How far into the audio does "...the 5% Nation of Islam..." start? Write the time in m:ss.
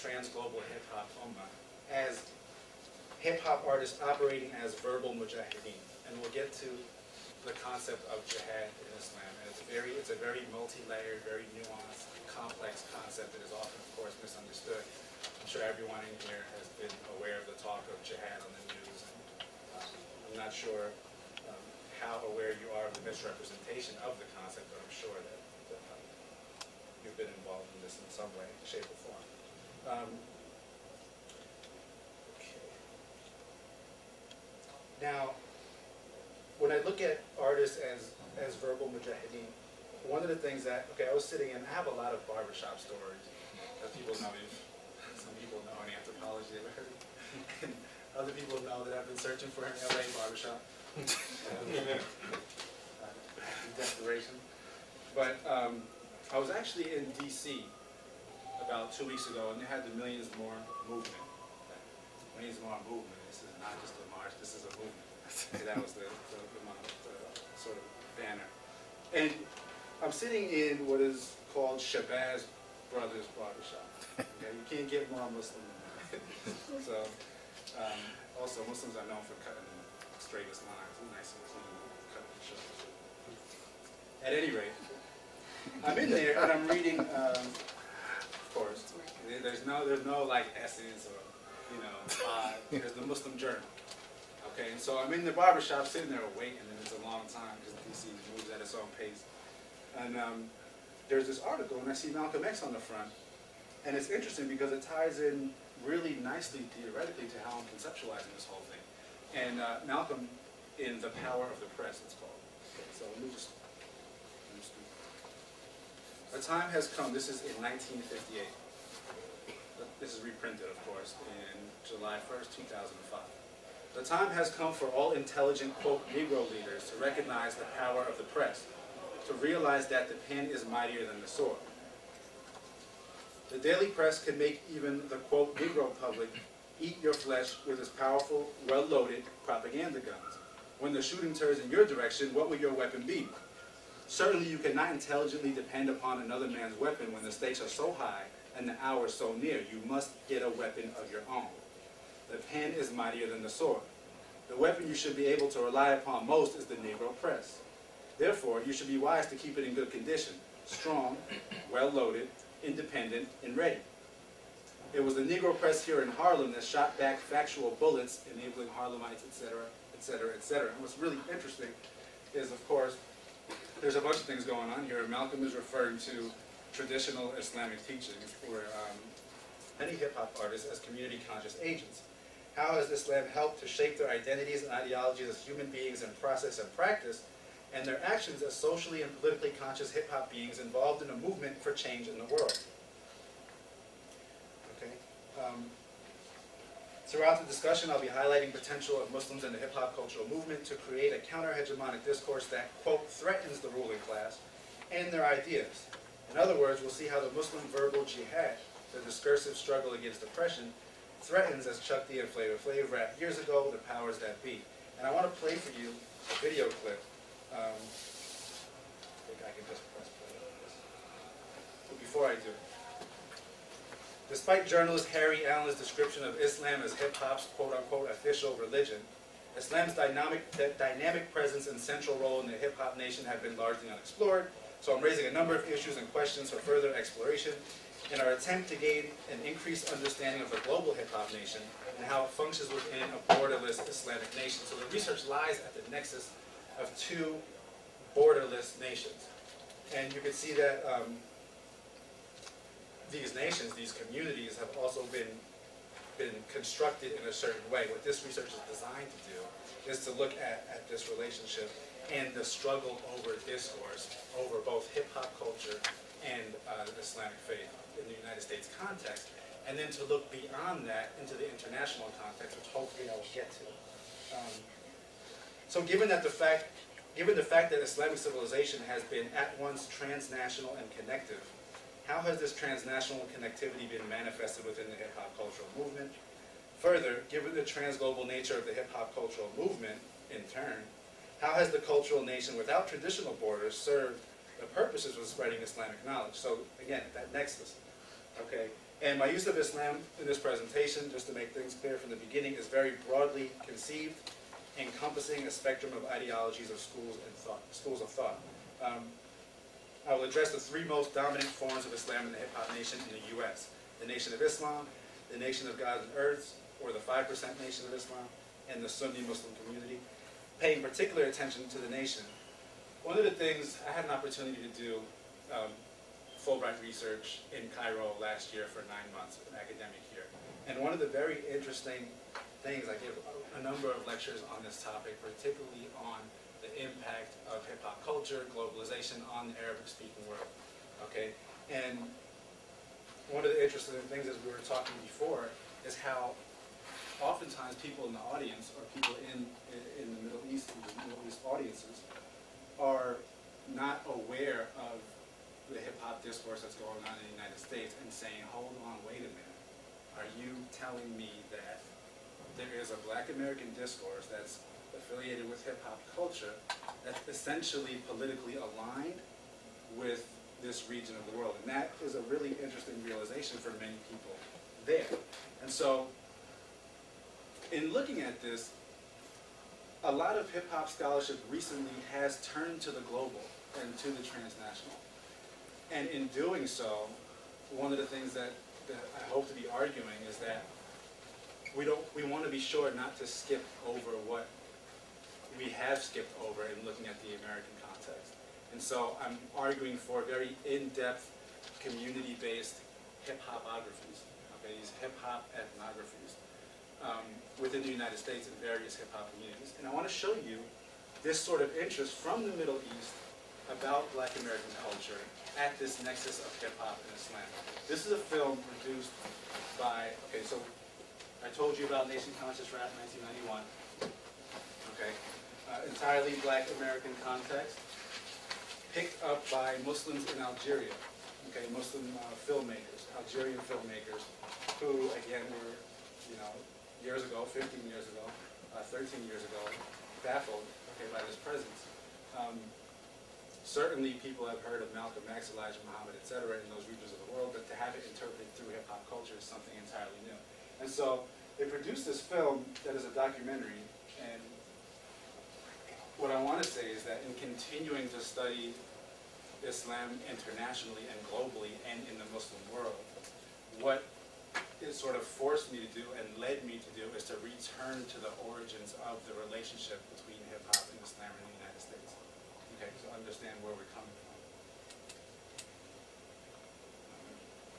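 5:16.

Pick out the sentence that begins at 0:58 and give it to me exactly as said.
about two weeks ago, and they had the Millions More movement.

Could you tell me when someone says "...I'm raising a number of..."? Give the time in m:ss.
3:54.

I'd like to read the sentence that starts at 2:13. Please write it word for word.
The daily press can make even the quote Negro public eat your flesh with its powerful, well loaded propaganda guns.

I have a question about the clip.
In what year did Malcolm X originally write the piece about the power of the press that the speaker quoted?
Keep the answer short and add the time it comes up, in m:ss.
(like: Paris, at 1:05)
1958, at 1:57.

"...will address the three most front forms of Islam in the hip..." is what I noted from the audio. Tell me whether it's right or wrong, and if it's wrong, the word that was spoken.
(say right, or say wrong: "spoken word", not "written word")
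wrong: "dominant", not "front".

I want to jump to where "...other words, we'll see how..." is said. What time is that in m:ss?
3:26.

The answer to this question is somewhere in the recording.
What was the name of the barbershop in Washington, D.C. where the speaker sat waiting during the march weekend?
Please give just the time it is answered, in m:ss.
1:11.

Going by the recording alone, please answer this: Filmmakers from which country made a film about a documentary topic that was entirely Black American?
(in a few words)
Algeria.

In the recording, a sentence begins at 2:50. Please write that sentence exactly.
And what's really interesting is, of course, there's a bunch of things going on here.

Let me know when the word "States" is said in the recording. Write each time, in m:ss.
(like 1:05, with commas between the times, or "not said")
4:28, 5:57, 6:48, 7:51.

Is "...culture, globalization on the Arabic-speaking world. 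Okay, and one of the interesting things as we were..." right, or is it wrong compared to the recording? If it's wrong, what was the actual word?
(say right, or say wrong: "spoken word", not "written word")
right.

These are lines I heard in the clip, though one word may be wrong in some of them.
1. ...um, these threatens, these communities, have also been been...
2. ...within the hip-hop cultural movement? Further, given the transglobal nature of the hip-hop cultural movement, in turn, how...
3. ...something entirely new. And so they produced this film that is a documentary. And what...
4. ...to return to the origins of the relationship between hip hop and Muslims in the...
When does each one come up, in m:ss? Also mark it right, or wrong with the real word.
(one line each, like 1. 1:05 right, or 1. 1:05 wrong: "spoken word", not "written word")
1. 4:10 wrong: "nations", not "threatens"
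2. 4:44 right
3. 7:29 right
4. 7:47 wrong: "Islam", not "Muslims".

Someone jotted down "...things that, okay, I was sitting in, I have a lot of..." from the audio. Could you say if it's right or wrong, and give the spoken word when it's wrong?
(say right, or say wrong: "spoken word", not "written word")
right.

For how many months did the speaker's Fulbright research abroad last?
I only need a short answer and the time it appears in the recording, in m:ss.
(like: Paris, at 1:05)
9, at 5:28.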